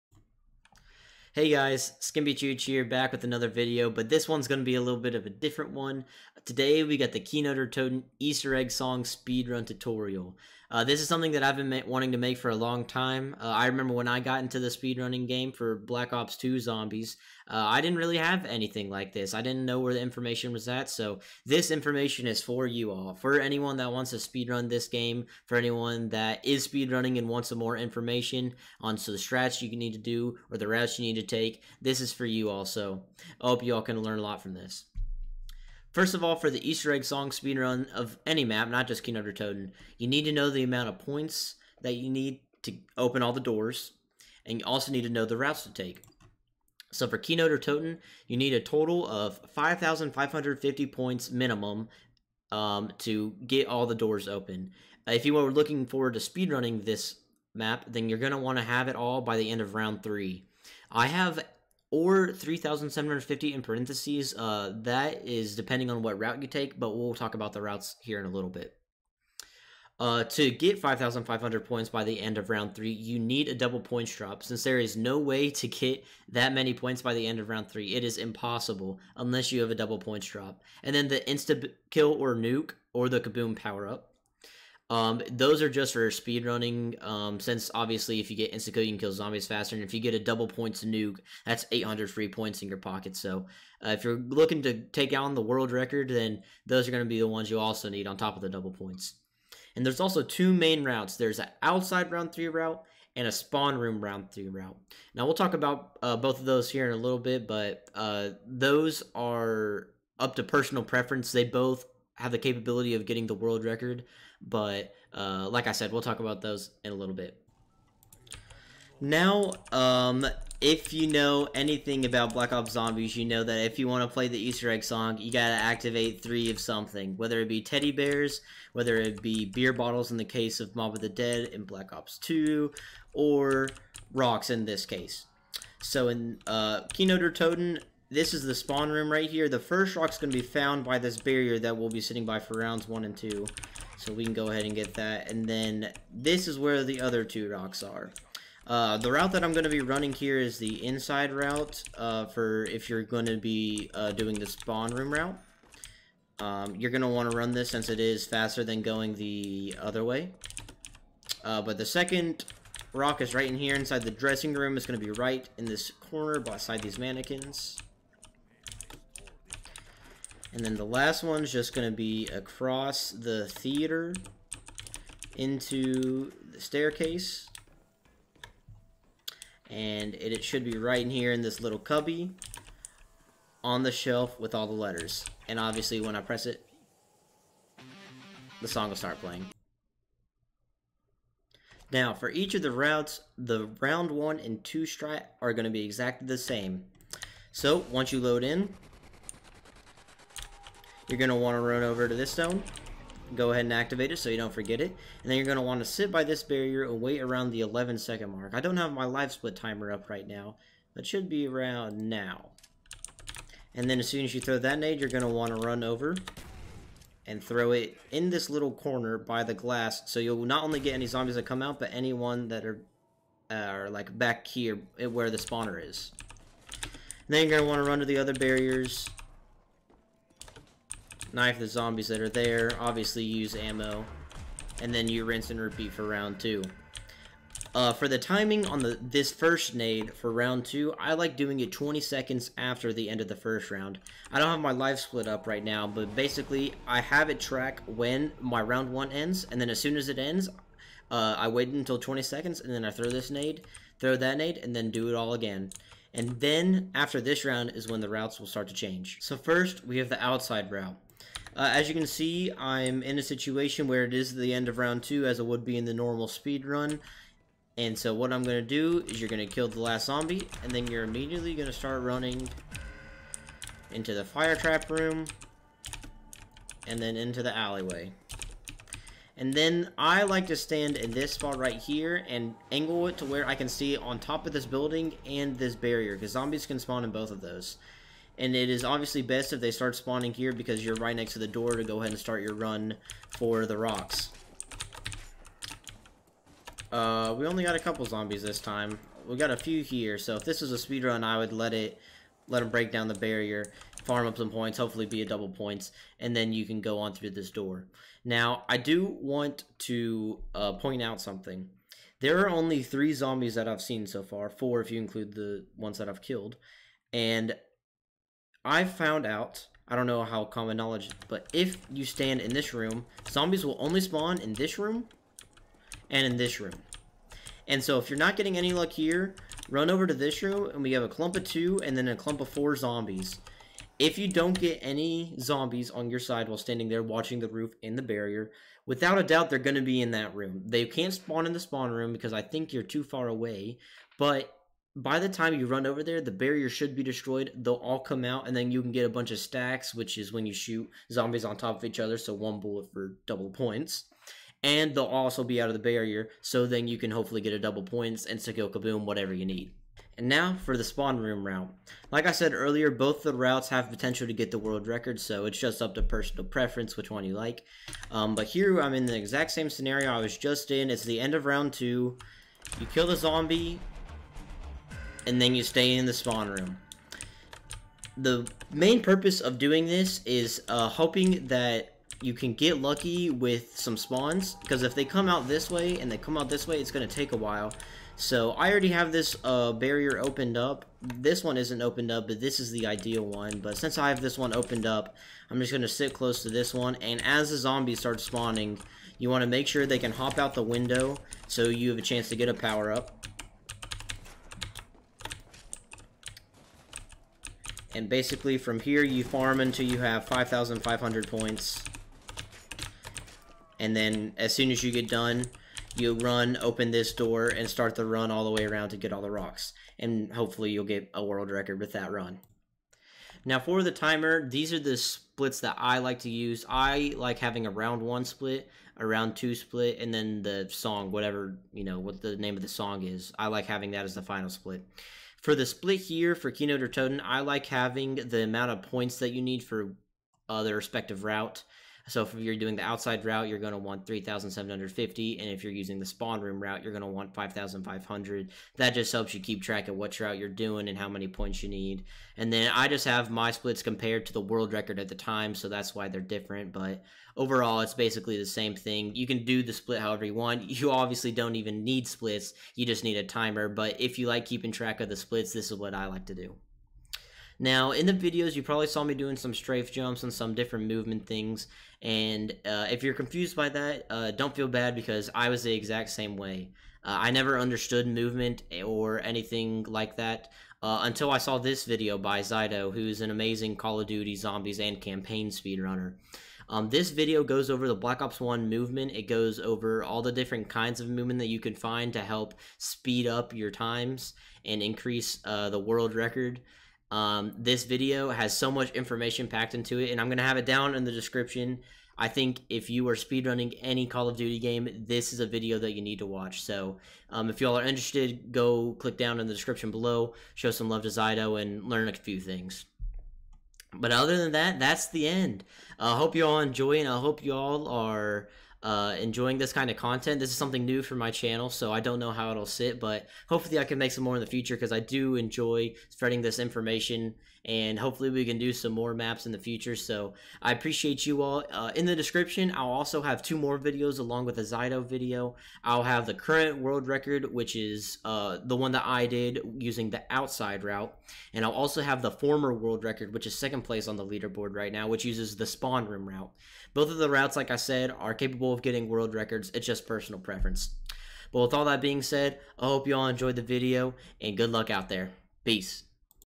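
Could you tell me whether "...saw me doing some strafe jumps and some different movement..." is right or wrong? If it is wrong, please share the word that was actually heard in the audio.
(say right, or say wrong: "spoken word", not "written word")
right.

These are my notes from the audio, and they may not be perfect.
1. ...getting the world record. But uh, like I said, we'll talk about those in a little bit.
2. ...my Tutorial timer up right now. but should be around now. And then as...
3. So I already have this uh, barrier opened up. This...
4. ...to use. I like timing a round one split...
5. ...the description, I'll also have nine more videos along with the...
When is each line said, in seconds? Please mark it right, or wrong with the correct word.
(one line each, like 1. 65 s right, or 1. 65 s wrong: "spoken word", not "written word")
1. 113 s right
2. 208 s wrong: "LiveSplit", not "Tutorial"
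3. 388 s right
4. 426 s wrong: "having", not "timing"
5. 532 s wrong: "two", not "nine".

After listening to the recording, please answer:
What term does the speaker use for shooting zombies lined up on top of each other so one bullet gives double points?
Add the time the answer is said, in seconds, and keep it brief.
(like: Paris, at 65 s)
Stacks, at 349 s.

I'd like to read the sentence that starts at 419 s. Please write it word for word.
And hopefully you'll get a world record with that run.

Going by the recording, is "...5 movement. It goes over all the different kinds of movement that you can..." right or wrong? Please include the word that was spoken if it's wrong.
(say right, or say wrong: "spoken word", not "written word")
wrong: "1", not "5".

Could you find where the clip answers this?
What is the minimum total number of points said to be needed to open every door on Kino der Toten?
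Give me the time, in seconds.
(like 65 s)
49 s.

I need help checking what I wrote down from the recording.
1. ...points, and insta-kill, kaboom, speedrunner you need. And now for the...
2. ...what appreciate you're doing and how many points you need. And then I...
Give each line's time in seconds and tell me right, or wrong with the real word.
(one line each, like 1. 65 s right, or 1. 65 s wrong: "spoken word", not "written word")
1. 357 s wrong: "whatever", not "speedrunner"
2. 449 s wrong: "route", not "appreciate".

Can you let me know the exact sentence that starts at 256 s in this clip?
And then, after this round, is when the routes will start to change.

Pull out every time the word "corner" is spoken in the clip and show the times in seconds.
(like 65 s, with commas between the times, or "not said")
166 s, 218 s.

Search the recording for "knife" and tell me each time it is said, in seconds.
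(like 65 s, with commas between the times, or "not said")
231 s.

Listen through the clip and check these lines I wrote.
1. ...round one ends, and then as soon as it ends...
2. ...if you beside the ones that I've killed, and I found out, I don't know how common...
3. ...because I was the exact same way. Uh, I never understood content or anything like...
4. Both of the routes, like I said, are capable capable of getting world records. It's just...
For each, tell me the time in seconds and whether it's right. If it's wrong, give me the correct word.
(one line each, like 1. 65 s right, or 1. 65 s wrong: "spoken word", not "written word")
1. 248 s right
2. 314 s wrong: "include", not "beside"
3. 474 s wrong: "movement", not "content"
4. 546 s right.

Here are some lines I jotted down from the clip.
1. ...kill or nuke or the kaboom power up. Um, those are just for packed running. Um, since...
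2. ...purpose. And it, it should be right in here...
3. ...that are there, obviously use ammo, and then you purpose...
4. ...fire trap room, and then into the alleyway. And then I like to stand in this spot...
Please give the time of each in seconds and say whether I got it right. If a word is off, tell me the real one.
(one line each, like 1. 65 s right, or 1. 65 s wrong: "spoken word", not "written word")
1. 81 s wrong: "speed", not "packed"
2. 176 s wrong: "staircase", not "purpose"
3. 232 s wrong: "rinse", not "purpose"
4. 274 s right.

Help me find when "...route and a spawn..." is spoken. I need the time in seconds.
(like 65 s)
102 s.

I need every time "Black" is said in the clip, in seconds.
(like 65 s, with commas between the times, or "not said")
15 s, 122 s, 131 s, 487 s.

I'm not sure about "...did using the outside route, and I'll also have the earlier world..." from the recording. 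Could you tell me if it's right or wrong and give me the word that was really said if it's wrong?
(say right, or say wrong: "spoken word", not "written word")
wrong: "former", not "earlier".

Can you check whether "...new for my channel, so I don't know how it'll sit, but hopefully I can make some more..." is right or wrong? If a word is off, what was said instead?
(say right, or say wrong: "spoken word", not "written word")
right.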